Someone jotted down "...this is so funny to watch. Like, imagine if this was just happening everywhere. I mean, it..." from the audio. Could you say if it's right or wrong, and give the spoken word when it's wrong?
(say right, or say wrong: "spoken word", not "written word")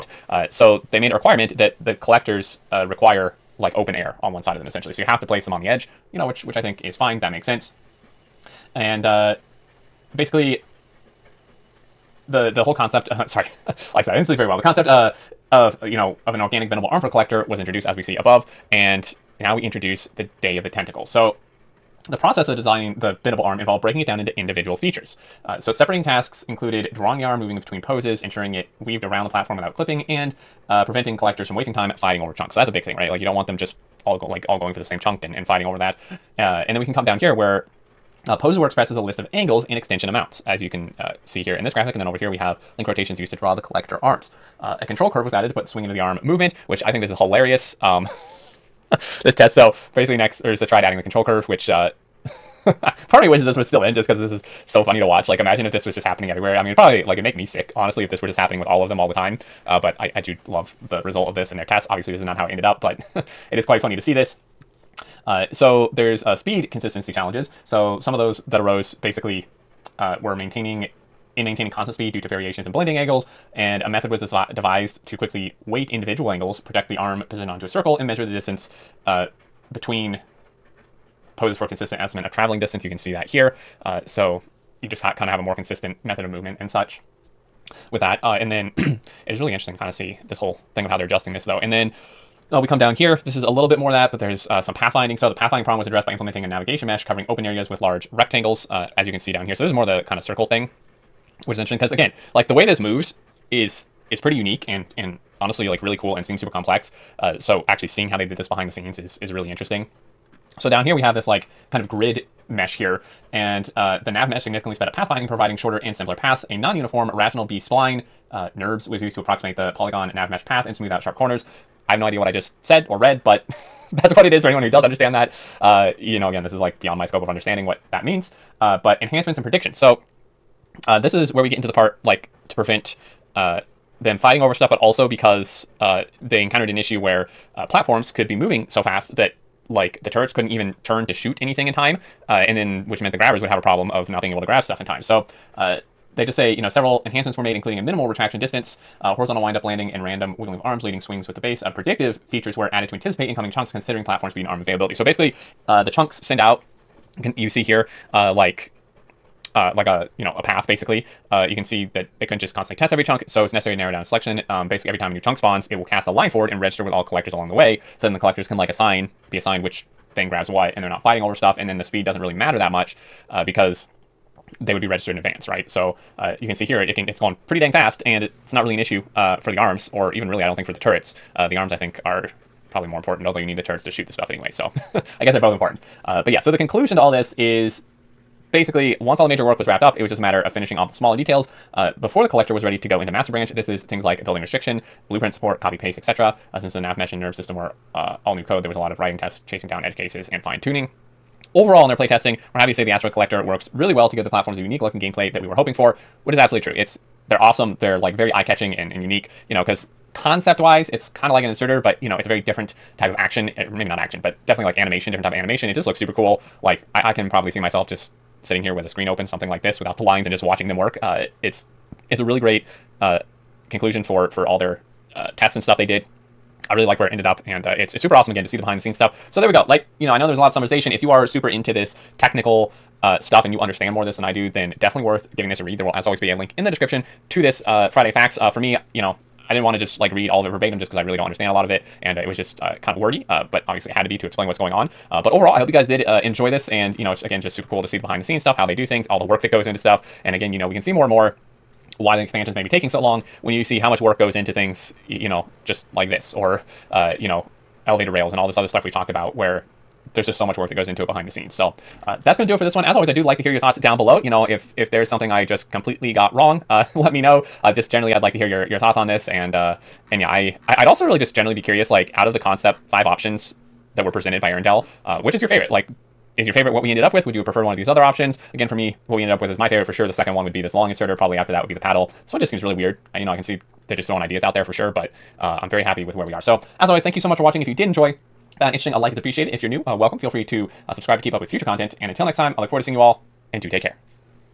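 right.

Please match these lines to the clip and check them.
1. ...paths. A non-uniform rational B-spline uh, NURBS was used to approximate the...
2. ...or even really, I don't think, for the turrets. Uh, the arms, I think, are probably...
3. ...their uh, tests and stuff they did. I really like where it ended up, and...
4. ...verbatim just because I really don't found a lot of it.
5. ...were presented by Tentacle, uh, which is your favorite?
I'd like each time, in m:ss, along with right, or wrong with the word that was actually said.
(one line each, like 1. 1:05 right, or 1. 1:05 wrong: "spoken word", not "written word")
1. 1:56 right
2. 2:59 right
3. 3:44 right
4. 4:00 wrong: "understand", not "found"
5. 4:34 wrong: "Earendel", not "Tentacle".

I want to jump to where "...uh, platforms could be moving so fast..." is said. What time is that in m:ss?
2:17.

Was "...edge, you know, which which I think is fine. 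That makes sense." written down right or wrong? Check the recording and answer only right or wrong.
right.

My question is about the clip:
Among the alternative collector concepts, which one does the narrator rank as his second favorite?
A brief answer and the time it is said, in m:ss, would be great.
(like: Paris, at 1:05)
Long inserter, at 4:40.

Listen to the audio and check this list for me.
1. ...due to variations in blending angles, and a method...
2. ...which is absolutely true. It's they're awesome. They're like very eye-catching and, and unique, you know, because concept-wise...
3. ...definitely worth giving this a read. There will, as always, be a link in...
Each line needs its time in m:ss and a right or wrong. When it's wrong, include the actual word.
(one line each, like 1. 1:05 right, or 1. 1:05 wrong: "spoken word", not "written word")
1. 1:12 right
2. 3:26 right
3. 3:54 right.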